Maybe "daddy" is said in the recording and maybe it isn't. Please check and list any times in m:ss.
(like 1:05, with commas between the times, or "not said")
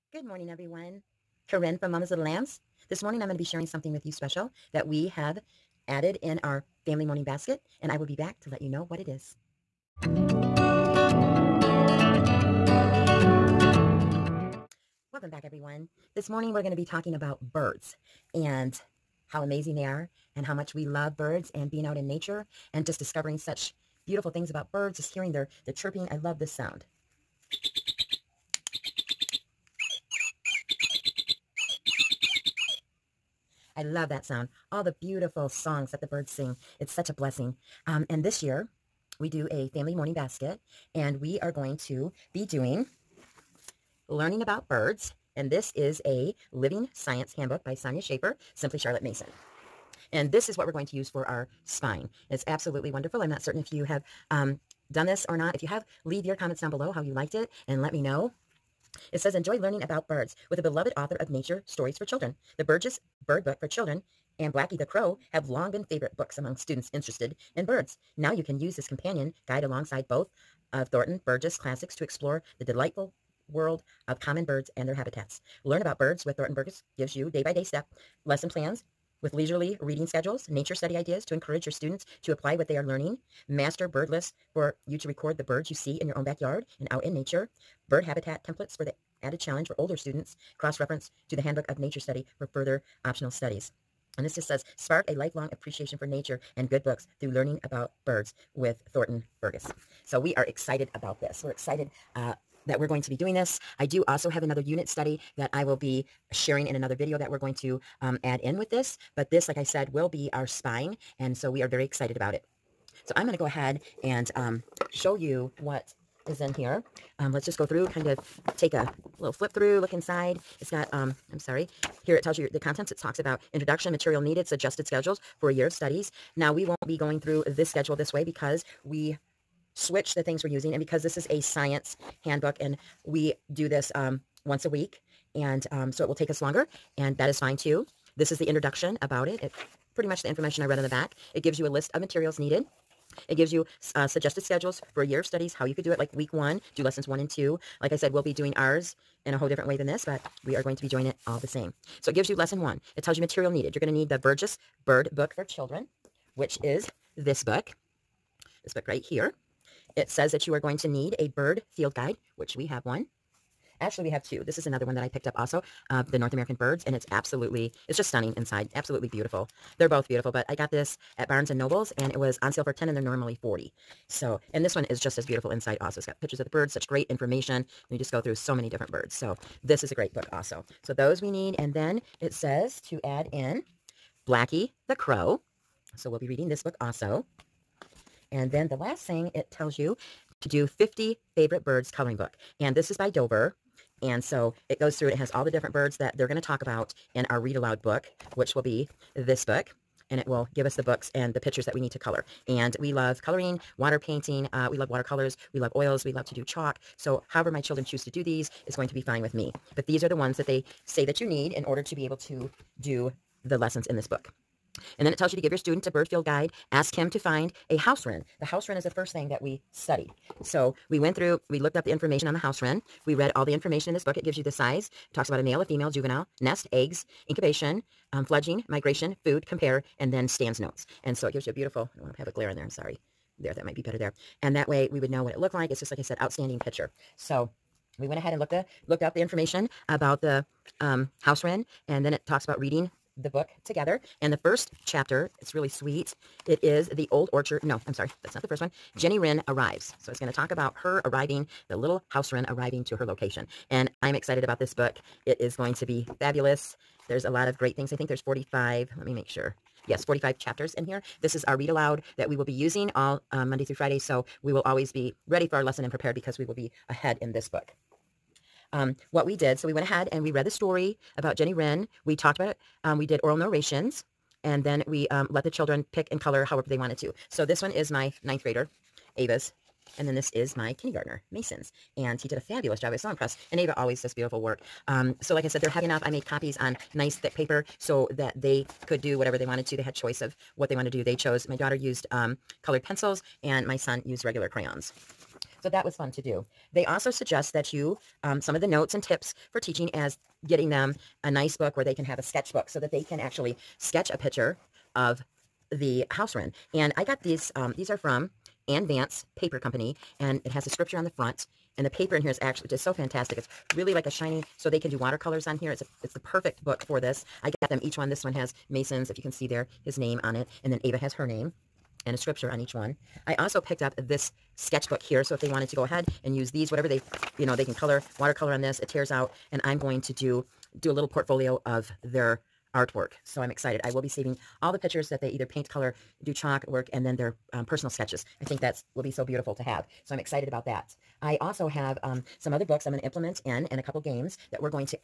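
not said.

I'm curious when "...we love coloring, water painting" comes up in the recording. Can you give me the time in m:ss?
3:22.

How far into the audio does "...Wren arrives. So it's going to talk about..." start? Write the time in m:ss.
4:09.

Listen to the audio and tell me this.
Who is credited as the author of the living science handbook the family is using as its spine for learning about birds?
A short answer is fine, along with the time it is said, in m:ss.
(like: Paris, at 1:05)
Sonya Shafer, at 0:47.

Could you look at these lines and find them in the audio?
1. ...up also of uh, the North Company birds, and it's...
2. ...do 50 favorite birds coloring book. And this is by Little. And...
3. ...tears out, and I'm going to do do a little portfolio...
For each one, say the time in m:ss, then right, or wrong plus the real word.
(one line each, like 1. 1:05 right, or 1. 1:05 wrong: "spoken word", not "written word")
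1. 2:45 wrong: "American", not "Company"
2. 3:10 wrong: "Dover", not "Little"
3. 5:28 right.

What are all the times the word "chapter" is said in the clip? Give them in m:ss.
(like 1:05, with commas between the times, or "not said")
4:04, 4:20.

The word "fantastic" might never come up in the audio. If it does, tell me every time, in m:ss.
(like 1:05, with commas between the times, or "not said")
5:12.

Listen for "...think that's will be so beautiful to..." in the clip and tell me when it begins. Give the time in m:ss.
5:38.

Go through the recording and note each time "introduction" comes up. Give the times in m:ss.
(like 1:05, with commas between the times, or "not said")
2:03, 2:18.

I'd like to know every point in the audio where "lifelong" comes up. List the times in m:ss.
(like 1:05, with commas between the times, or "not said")
1:35.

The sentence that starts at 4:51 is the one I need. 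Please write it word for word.
They chose, my daughter used um, colored pencils, and my son used regular crayons.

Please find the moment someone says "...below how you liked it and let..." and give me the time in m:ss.
0:56.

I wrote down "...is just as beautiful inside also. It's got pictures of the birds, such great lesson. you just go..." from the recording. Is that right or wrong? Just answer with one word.
wrong.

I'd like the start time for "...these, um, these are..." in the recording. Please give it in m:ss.
5:07.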